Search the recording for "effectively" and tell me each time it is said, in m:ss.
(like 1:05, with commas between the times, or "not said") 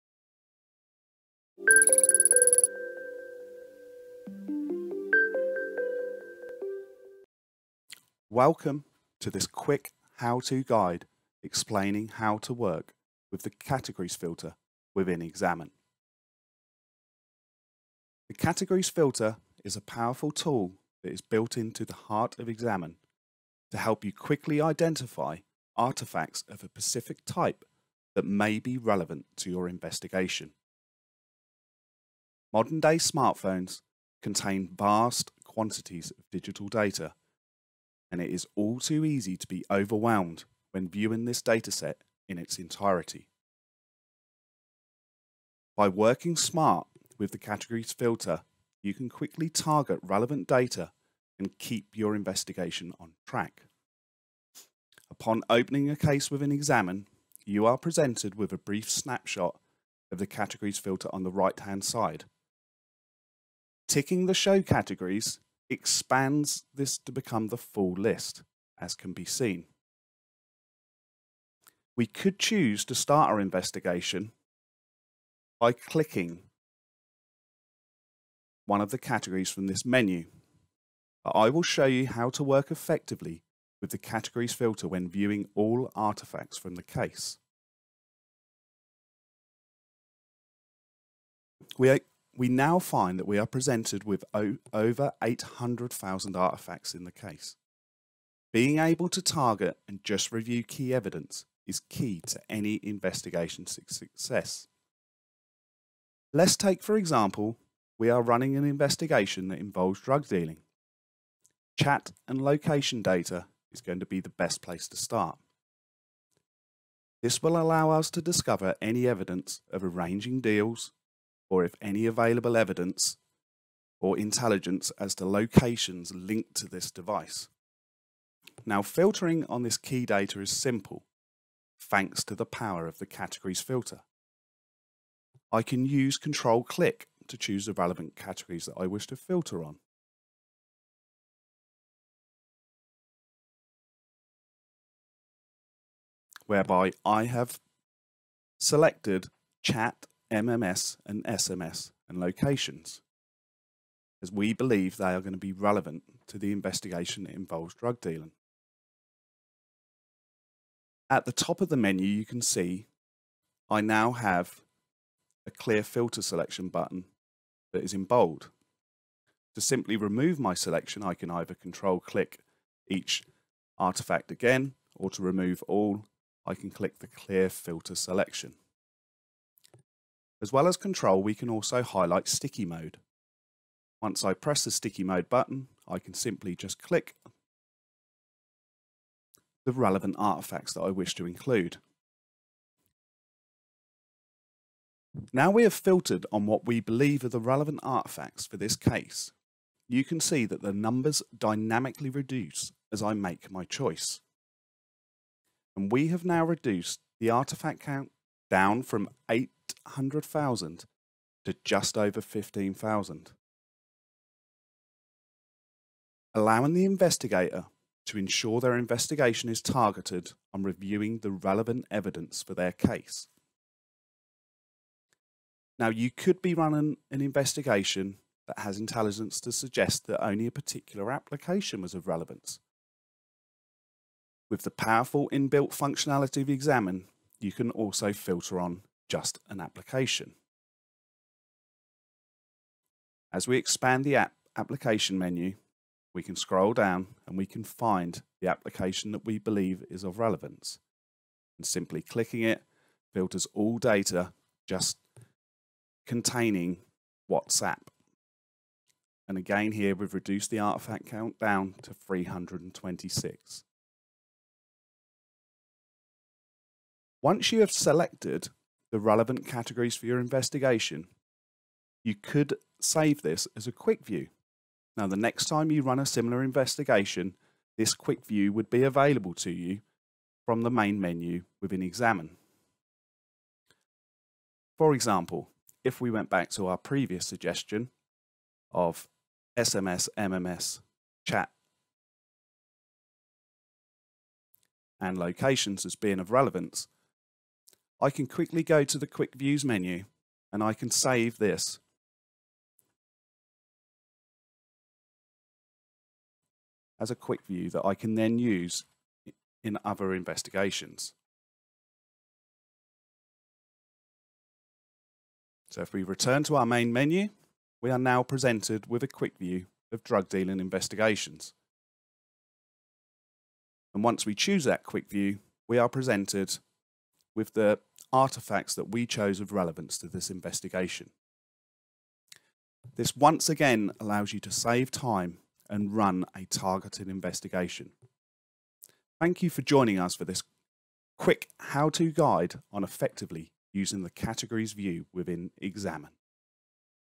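1:22, 5:42.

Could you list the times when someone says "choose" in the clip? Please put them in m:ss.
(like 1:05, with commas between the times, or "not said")
1:12, 2:17, 5:24.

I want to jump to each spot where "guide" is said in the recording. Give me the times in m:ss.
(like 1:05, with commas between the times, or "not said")
0:10, 5:42.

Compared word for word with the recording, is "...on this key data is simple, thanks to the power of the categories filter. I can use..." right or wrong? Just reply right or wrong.
right.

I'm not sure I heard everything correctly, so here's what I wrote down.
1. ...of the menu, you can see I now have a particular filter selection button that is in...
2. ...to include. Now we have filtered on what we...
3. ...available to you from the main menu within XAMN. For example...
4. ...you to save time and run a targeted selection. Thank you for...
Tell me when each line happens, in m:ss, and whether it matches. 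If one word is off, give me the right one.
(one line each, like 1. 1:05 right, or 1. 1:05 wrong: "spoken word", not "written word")
1. 2:41 wrong: "clear", not "particular"
2. 3:11 right
3. 4:38 right
4. 5:34 wrong: "investigation", not "selection".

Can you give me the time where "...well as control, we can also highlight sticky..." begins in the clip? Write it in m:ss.
3:00.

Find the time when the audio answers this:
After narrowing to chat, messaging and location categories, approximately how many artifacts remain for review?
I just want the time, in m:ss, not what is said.
3:31.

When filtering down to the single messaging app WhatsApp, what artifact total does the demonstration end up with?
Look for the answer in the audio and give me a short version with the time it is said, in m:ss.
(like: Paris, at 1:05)
326, at 4:21.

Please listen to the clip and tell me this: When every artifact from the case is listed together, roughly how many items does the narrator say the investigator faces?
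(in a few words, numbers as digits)
over 800,000.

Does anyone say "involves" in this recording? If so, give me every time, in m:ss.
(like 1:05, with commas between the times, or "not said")
1:49, 2:37.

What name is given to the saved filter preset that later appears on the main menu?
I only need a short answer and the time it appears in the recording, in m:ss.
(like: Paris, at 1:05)
drug dealing investigations, at 5:20.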